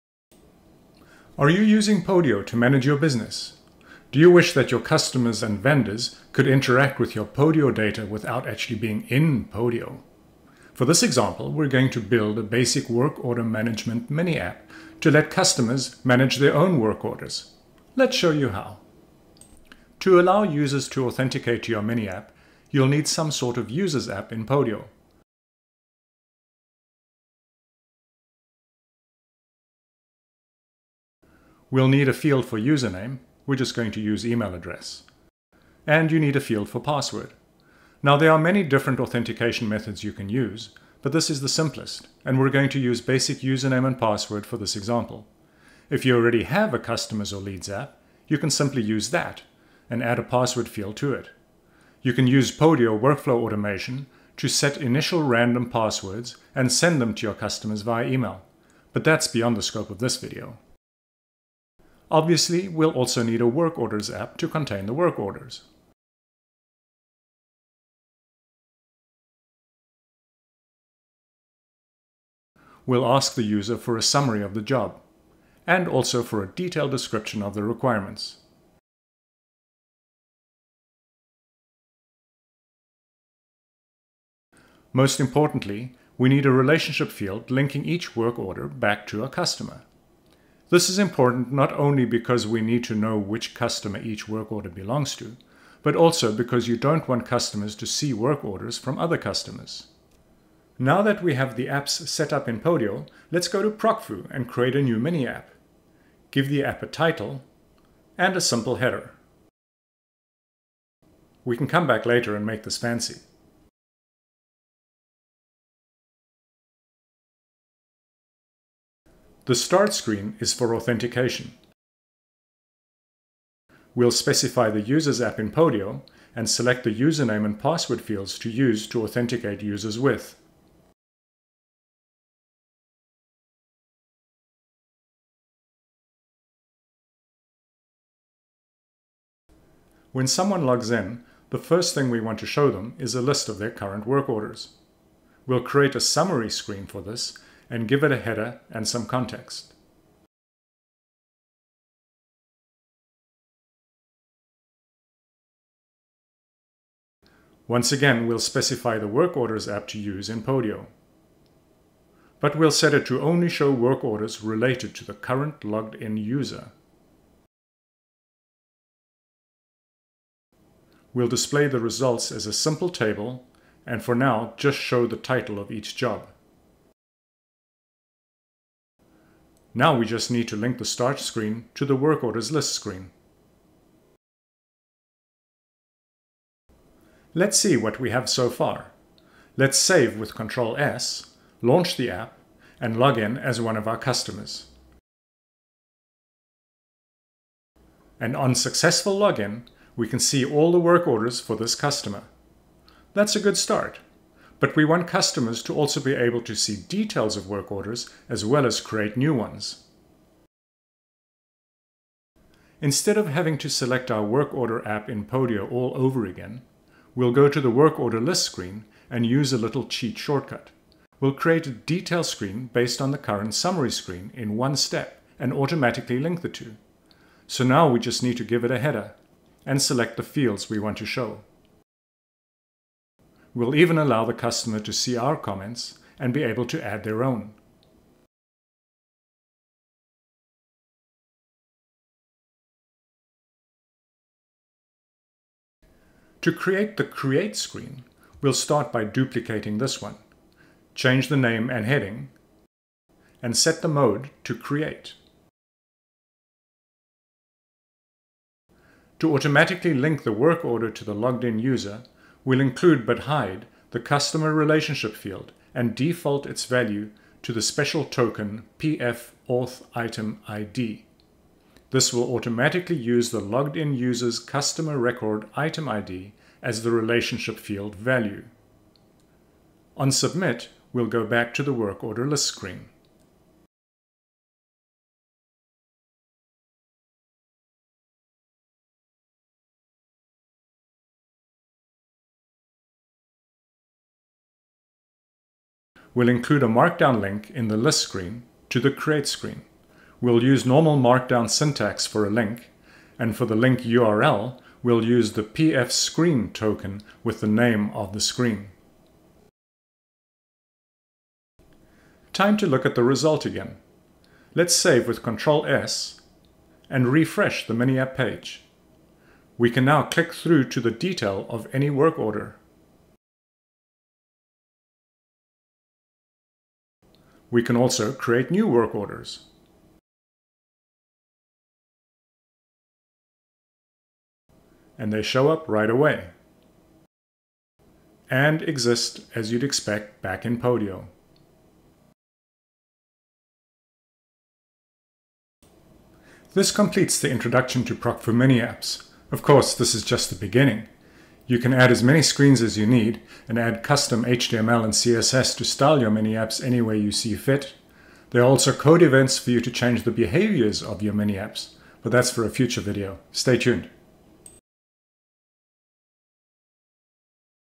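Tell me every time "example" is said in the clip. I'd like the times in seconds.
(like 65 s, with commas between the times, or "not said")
11 s, 44 s.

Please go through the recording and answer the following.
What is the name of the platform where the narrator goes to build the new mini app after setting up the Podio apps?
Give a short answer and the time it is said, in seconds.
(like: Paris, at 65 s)
Procfu, at 103 s.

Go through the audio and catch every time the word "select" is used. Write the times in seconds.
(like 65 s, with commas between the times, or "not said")
126 s, 213 s, 229 s.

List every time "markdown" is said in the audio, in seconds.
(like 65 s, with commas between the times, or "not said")
296 s, 300 s.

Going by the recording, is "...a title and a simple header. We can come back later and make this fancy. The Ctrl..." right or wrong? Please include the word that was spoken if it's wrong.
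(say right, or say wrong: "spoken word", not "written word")
wrong: "Start", not "Ctrl".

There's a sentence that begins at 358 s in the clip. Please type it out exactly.
There are also code events for you to change the behaviors of your mini apps, but that's for a future video.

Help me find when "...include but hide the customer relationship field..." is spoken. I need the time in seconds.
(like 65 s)
262 s.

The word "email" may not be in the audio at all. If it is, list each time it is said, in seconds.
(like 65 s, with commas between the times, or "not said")
34 s, 58 s.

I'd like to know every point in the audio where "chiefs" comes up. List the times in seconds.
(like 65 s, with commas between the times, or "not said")
not said.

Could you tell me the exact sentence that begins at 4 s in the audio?
Do you wish that your customers and vendors could interact with your Podio data without actually being in Podio?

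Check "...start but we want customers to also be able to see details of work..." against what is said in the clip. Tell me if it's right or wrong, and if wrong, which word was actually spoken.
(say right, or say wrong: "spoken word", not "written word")
right.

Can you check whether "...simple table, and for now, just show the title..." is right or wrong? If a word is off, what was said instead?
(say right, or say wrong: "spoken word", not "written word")
right.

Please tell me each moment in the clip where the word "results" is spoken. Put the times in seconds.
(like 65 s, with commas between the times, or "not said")
171 s, 313 s.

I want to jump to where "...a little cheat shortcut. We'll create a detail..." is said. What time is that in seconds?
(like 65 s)
219 s.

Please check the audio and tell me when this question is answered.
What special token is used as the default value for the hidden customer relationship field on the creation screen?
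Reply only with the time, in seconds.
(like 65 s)
268 s.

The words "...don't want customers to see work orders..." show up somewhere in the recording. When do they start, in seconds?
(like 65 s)
96 s.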